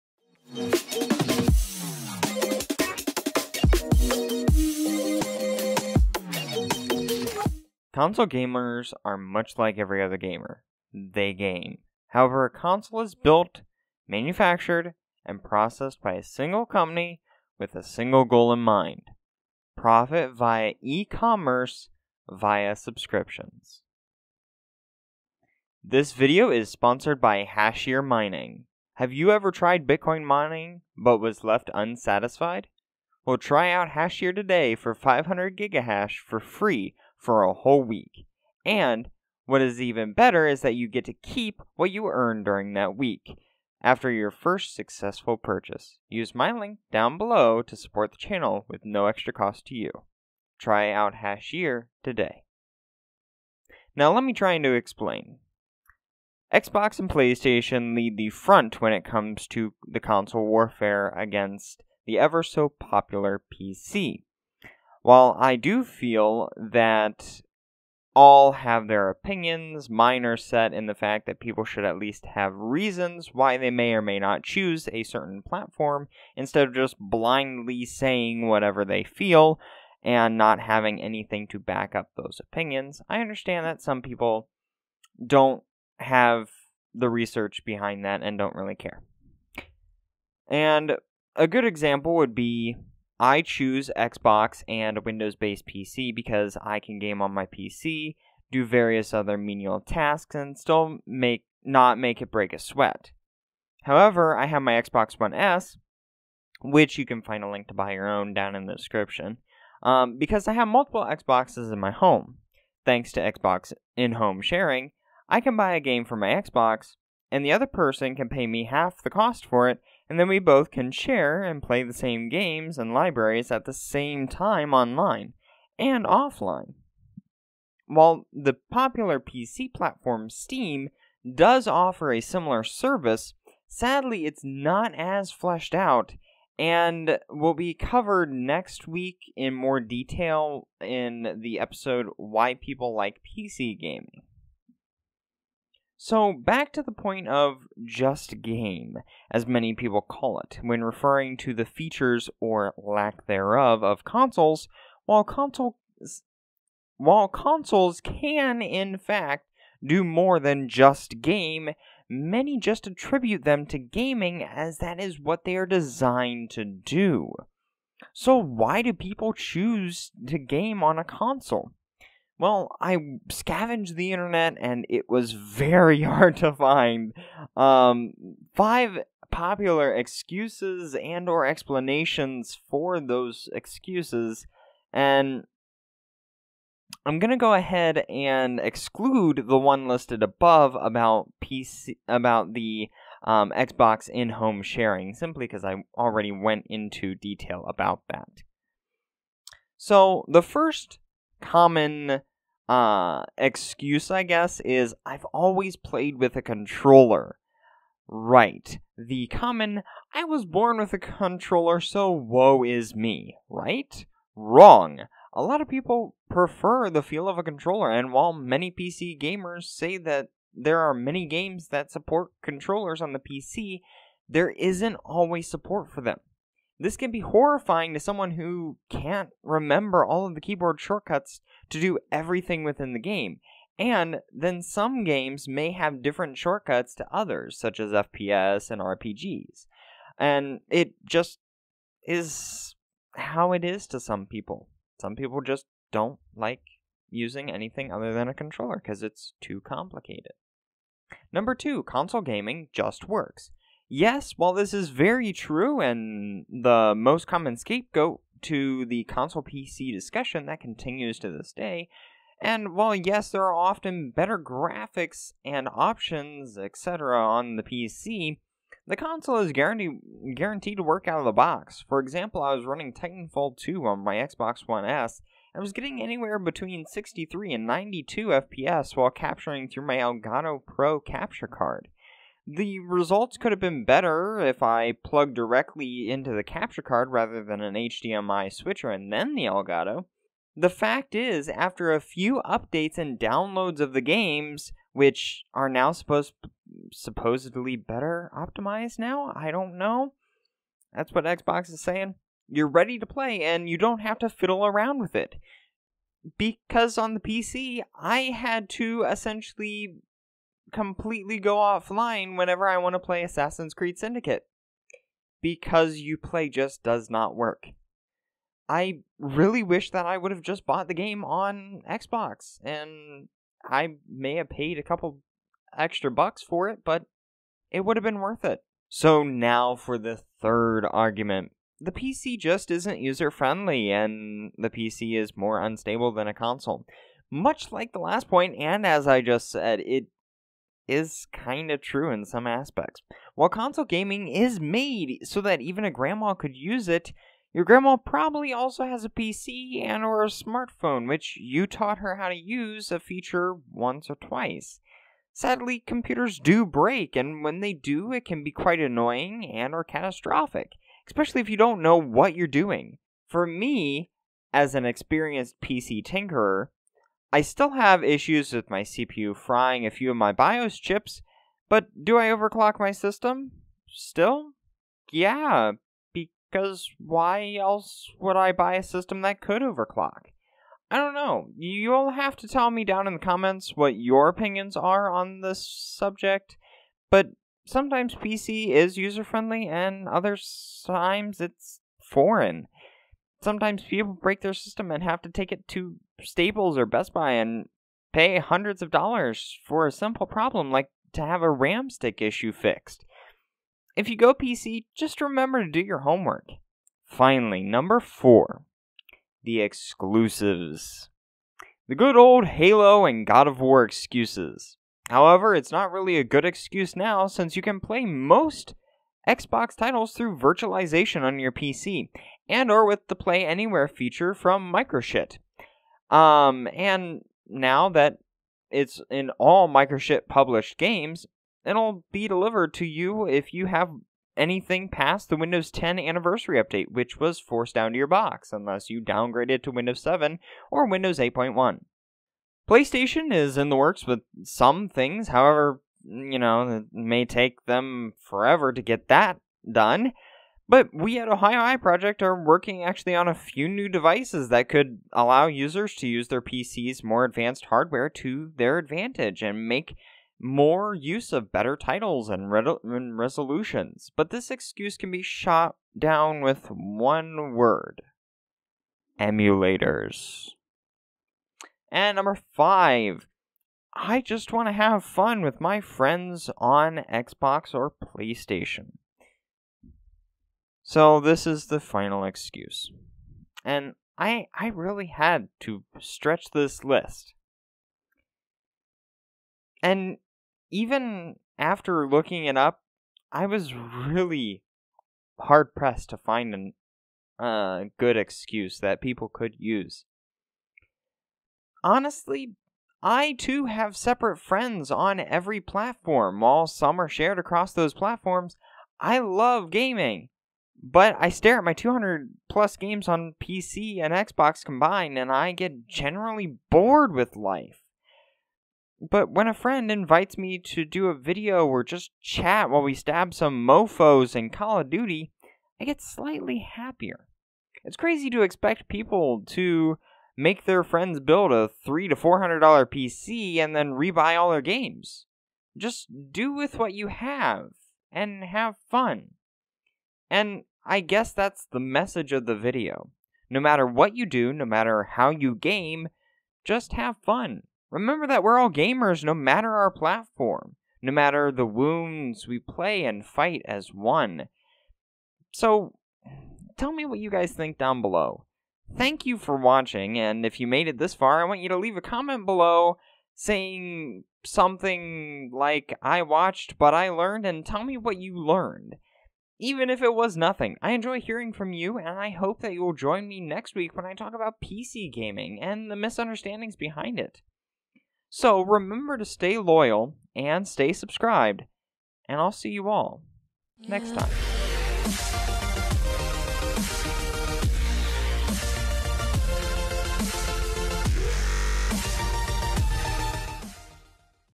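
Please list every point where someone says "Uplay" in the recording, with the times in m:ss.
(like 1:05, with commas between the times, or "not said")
5:16.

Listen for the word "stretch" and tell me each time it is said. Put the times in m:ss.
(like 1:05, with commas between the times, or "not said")
8:06.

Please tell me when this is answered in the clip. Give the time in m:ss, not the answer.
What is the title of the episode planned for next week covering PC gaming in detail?
2:22.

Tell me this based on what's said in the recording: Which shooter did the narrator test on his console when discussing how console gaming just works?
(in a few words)
Titanfall 2.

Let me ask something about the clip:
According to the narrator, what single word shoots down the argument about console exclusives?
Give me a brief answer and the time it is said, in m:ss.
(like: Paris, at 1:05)
Emulators, at 7:49.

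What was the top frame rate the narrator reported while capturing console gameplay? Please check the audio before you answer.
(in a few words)
92 FPS.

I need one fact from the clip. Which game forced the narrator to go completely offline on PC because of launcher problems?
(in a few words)
Assassin's Creed Syndicate.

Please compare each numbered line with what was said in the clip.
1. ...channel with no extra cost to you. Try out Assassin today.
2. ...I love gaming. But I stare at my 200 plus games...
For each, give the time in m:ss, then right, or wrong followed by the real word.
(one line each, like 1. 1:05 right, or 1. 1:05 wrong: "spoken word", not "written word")
1. 0:48 wrong: "Hashier", not "Assassin"
2. 8:28 right.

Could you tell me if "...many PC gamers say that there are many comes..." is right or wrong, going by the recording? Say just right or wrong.
wrong.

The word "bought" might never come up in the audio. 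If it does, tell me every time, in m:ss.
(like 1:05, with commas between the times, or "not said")
5:20.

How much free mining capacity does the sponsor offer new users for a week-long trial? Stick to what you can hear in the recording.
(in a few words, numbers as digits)
500 gigahash.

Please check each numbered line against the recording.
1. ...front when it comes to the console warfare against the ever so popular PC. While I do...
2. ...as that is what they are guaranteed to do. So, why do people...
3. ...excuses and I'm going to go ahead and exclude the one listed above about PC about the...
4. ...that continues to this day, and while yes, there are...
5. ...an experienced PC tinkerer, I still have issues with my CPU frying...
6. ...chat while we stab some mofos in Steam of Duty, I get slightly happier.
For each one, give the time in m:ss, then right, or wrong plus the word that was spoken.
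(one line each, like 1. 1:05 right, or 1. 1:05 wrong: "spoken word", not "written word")
1. 0:58 right
2. 2:44 wrong: "designed", not "guaranteed"
3. 3:03 right
4. 4:20 right
5. 6:04 right
6. 8:42 wrong: "Call", not "Steam".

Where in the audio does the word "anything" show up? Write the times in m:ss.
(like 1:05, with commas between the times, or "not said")
1:21, 4:07, 7:14.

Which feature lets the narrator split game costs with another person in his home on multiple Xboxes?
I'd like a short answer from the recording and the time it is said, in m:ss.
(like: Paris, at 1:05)
Xbox in-home sharing, at 1:53.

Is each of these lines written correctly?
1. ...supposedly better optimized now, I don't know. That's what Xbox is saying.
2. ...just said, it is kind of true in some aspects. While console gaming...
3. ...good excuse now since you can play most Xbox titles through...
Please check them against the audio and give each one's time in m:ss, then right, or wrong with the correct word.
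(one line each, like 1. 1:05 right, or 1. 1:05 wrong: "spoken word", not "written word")
1. 4:56 right
2. 5:39 right
3. 6:56 right.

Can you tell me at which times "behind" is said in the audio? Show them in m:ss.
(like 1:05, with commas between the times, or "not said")
1:27, 9:36.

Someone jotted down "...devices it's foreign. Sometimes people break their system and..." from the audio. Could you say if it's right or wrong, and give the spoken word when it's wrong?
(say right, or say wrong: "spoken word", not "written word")
wrong: "times", not "devices".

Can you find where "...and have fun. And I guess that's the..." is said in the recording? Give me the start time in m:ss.
8:58.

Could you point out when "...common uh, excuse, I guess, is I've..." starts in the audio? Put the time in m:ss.
3:21.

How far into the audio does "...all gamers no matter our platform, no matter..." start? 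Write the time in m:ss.
9:08.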